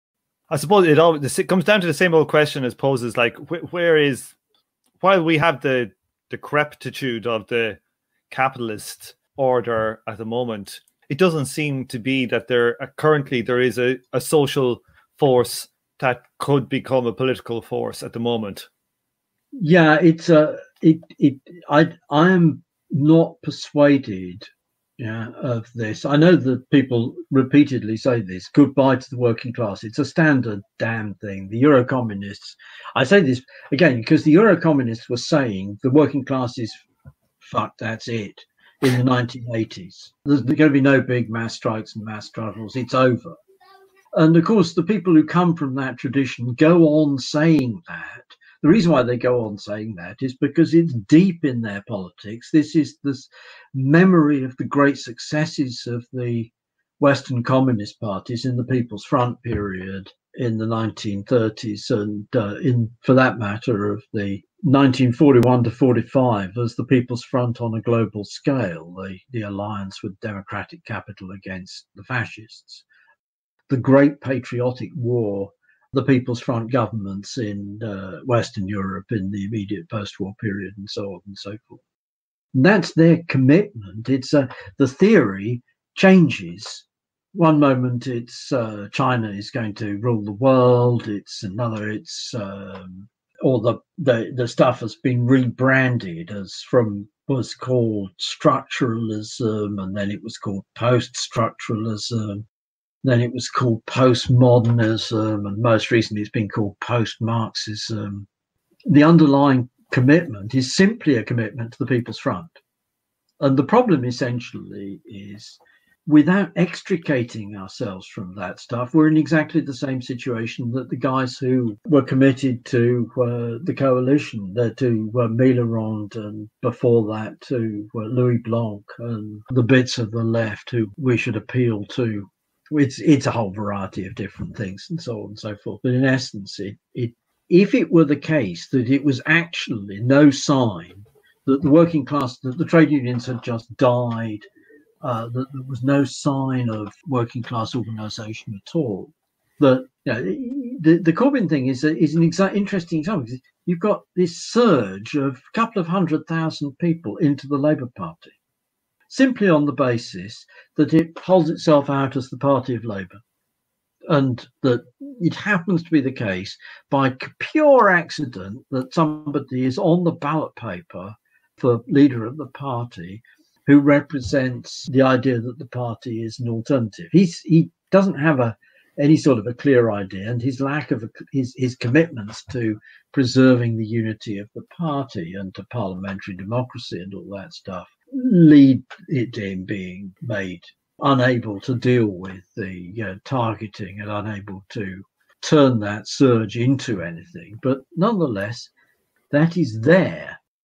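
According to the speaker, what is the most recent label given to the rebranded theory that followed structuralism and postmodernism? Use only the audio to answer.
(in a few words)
post Marxism.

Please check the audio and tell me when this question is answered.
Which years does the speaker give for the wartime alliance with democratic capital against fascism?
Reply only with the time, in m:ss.
1:04.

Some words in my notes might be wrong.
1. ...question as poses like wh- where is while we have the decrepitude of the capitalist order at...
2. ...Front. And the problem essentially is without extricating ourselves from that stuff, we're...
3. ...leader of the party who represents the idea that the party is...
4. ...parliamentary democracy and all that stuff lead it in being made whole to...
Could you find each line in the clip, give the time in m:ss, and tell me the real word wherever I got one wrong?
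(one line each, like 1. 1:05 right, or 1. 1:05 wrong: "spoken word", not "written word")
1. 0:02 right
2. 1:52 right
3. 2:51 right
4. 3:05 wrong: "unable", not "whole".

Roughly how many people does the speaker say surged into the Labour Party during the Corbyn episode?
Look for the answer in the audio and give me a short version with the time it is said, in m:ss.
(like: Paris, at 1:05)
a couple of hundred thousand, at 2:35.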